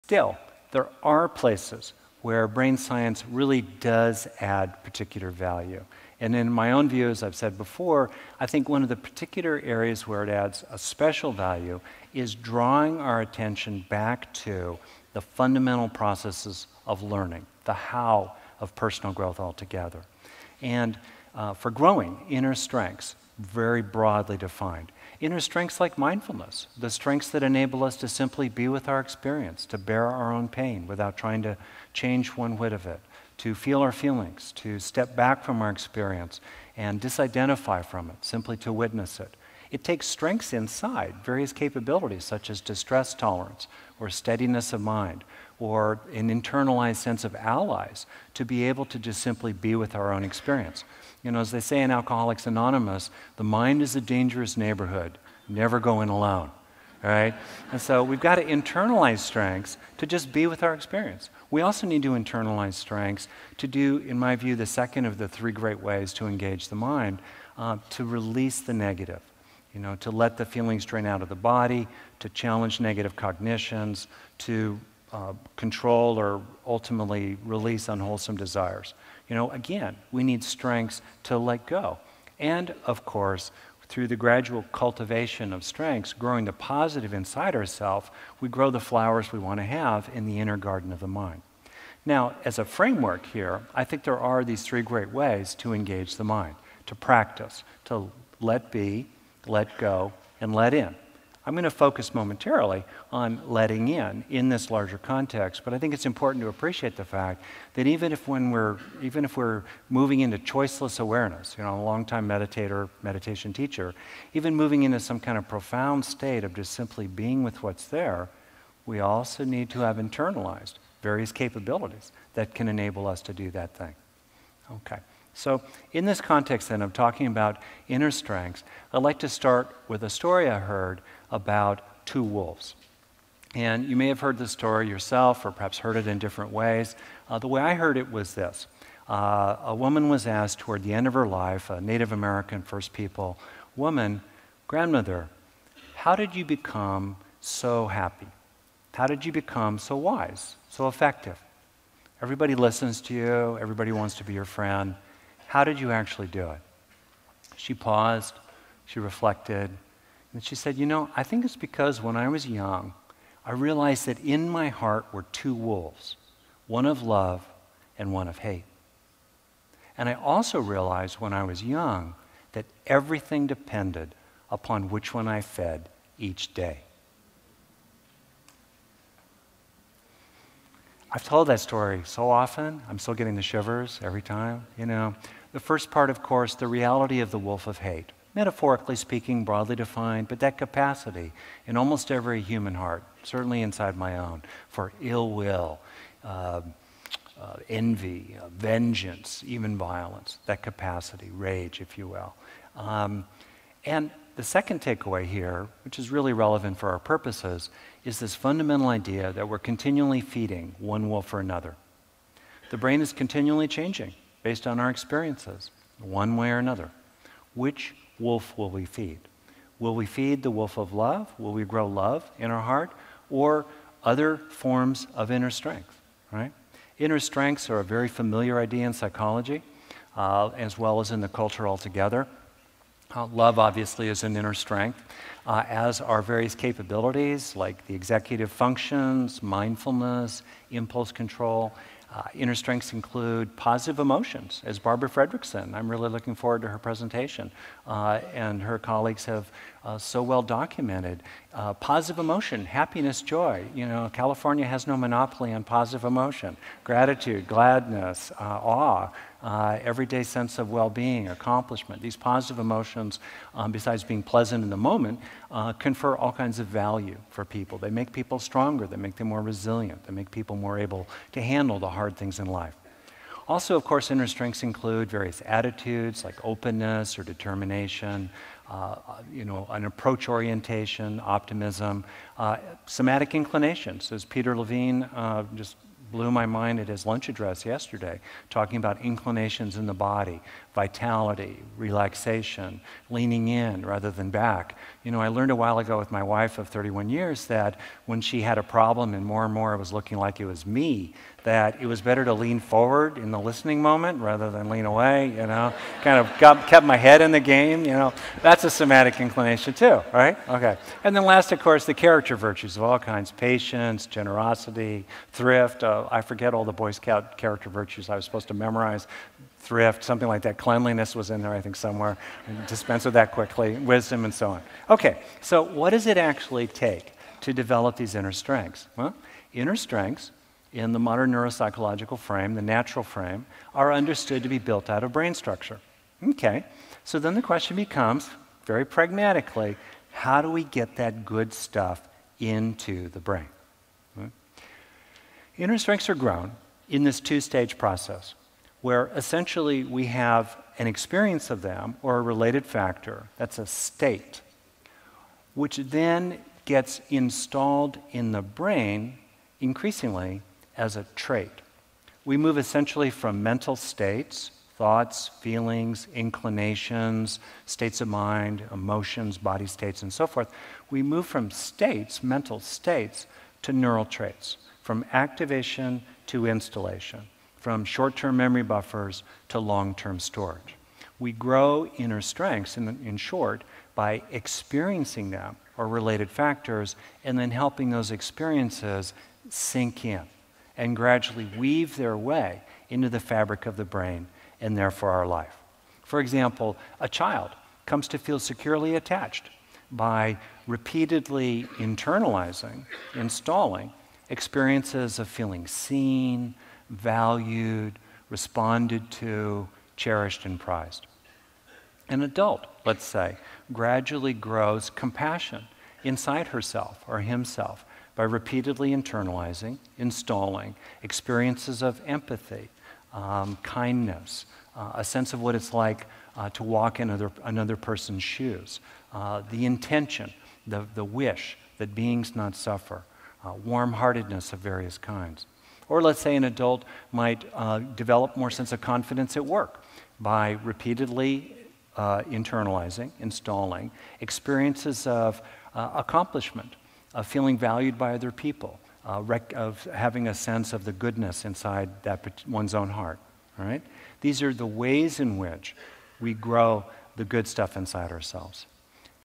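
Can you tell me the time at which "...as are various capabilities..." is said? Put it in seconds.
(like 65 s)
235 s.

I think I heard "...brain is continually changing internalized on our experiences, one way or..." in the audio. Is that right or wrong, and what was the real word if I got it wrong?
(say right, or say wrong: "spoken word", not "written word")
wrong: "based", not "internalized".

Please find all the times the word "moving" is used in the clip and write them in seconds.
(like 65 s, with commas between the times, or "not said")
109 s, 114 s.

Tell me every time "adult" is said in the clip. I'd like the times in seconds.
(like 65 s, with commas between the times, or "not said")
412 s, 436 s.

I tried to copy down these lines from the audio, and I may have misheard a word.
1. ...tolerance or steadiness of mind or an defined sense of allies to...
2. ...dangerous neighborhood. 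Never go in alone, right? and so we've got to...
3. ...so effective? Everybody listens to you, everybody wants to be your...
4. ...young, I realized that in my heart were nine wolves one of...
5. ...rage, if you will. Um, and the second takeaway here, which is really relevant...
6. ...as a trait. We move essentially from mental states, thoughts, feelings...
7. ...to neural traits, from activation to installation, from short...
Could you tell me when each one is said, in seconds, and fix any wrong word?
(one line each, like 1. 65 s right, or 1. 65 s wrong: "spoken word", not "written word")
1. 43 s wrong: "internalized", not "defined"
2. 54 s right
3. 150 s right
4. 162 s wrong: "two", not "nine"
5. 201 s right
6. 360 s right
7. 373 s right.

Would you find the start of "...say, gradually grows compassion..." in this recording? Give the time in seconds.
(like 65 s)
413 s.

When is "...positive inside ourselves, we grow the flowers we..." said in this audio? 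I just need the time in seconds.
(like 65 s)
86 s.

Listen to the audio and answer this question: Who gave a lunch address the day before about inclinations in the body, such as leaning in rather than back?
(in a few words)
Peter Levine.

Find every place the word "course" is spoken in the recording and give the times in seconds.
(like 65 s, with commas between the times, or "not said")
83 s, 186 s, 273 s, 311 s.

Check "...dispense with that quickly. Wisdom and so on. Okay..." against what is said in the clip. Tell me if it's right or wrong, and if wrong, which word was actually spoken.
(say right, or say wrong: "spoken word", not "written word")
right.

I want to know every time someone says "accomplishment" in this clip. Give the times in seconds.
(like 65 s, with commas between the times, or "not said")
261 s, 445 s.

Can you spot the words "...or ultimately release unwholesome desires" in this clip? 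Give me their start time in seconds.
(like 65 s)
76 s.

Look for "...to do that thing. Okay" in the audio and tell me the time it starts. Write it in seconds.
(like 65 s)
123 s.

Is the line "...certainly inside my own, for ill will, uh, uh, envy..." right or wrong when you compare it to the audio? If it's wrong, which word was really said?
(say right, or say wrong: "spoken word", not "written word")
right.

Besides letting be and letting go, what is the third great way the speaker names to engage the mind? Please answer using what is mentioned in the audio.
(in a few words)
let in.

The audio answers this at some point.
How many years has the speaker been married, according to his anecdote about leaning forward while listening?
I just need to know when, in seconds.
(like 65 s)
296 s.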